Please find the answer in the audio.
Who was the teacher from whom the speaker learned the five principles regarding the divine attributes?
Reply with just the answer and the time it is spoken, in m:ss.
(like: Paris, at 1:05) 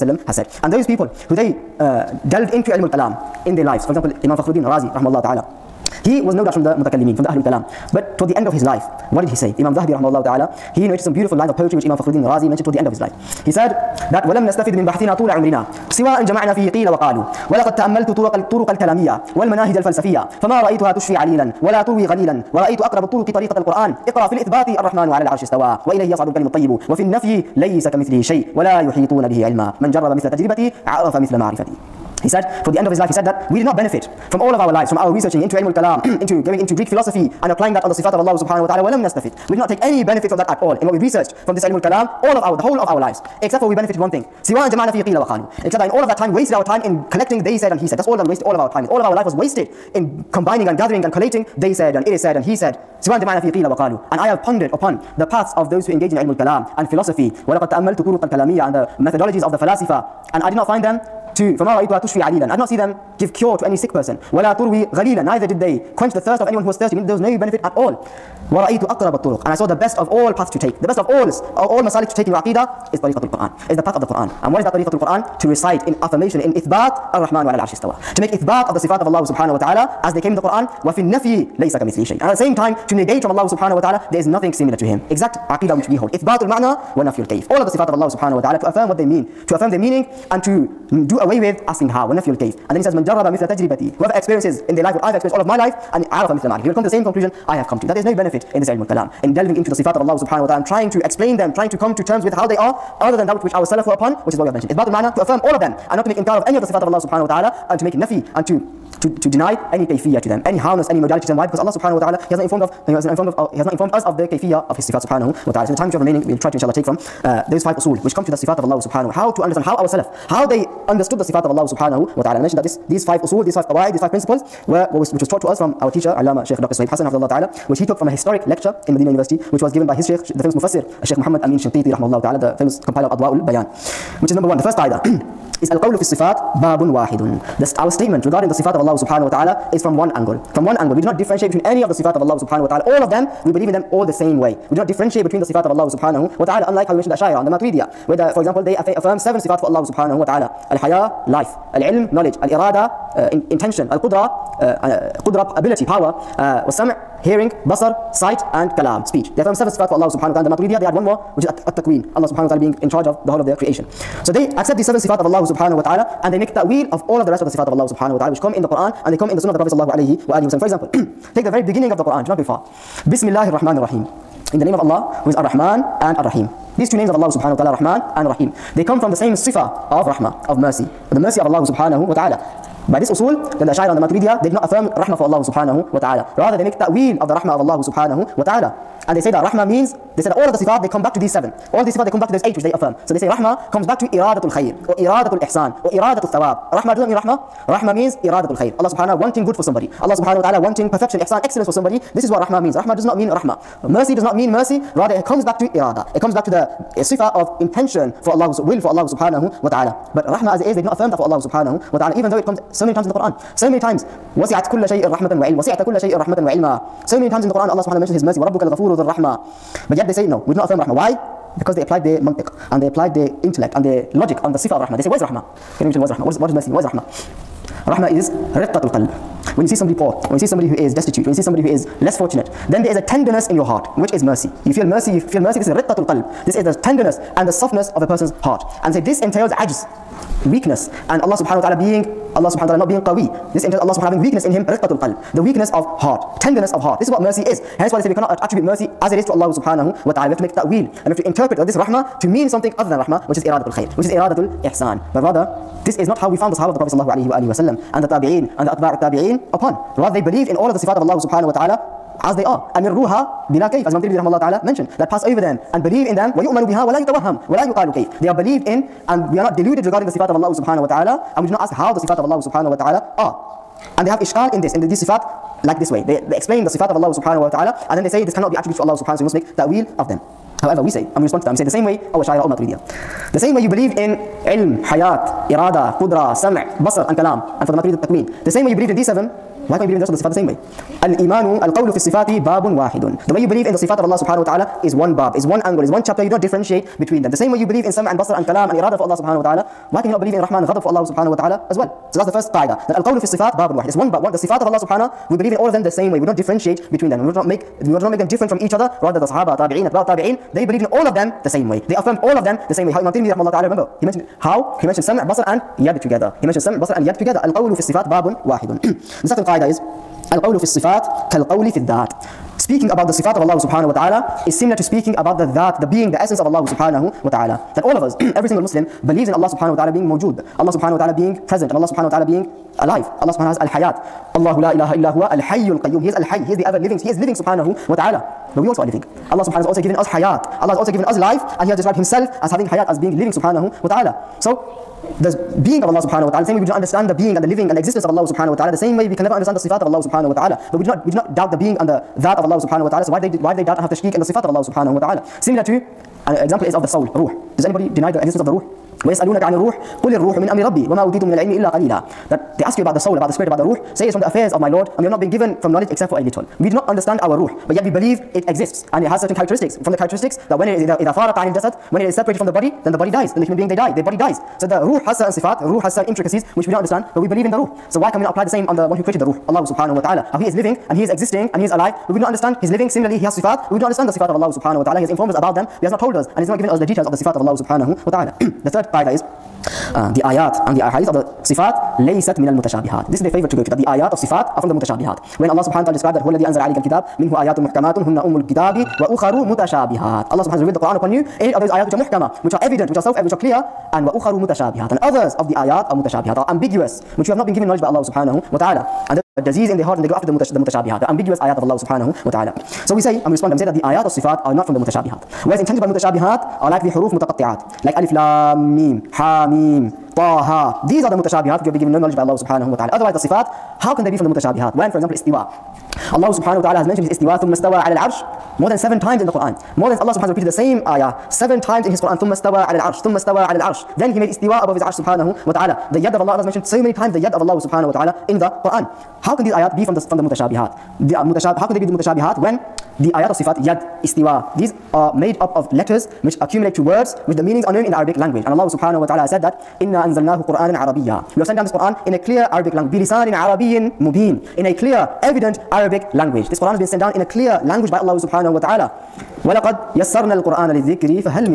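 Sheikh Dr. Suhaib Hassan, at 2:06.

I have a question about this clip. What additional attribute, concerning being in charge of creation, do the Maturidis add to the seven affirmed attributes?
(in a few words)
at-takween.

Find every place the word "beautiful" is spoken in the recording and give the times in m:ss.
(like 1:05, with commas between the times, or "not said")
0:11.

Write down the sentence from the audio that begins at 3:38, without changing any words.
وَرَبُّكَ الْغَفُورُ ذُو الرَّحْمَةِ But yet they say, no, we do not affirm rahmah.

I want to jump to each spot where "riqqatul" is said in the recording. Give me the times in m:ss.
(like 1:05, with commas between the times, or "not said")
3:48, 3:55, 4:04.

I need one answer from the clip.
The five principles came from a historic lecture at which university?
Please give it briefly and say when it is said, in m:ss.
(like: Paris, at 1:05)
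Medina University, at 2:08.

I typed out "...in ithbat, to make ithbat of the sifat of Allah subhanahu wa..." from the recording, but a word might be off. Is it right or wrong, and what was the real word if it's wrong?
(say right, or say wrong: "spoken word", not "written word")
right.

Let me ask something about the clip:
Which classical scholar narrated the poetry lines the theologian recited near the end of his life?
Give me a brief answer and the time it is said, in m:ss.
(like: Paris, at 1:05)
Imam Zahabi, at 0:09.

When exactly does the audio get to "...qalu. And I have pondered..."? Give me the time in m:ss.
0:53.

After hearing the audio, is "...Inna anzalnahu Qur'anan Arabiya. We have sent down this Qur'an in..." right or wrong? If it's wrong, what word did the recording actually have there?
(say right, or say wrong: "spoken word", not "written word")
right.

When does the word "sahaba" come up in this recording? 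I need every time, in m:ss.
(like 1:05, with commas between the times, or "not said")
4:16, 5:09.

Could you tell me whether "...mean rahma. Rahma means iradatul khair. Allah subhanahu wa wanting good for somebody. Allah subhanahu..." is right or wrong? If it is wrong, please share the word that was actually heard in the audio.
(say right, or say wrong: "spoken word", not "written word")
right.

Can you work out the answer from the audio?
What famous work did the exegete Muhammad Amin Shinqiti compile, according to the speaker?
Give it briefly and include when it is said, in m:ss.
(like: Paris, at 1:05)
Adwa'ul Bayan, at 2:13.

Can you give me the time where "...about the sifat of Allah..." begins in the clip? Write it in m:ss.
5:22.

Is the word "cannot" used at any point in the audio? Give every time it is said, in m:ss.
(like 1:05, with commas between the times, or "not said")
4:08, 4:38.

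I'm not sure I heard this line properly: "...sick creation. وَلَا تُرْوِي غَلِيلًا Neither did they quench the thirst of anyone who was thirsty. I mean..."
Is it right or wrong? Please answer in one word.
wrong.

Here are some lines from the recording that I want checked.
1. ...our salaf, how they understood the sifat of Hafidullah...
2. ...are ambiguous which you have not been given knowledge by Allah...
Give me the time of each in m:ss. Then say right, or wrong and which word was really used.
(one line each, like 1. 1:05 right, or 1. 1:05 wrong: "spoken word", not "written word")
1. 1:59 wrong: "Allah", not "Hafidullah"
2. 6:46 right.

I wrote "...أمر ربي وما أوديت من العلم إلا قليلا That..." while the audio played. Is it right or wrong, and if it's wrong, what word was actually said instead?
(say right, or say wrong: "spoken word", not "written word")
right.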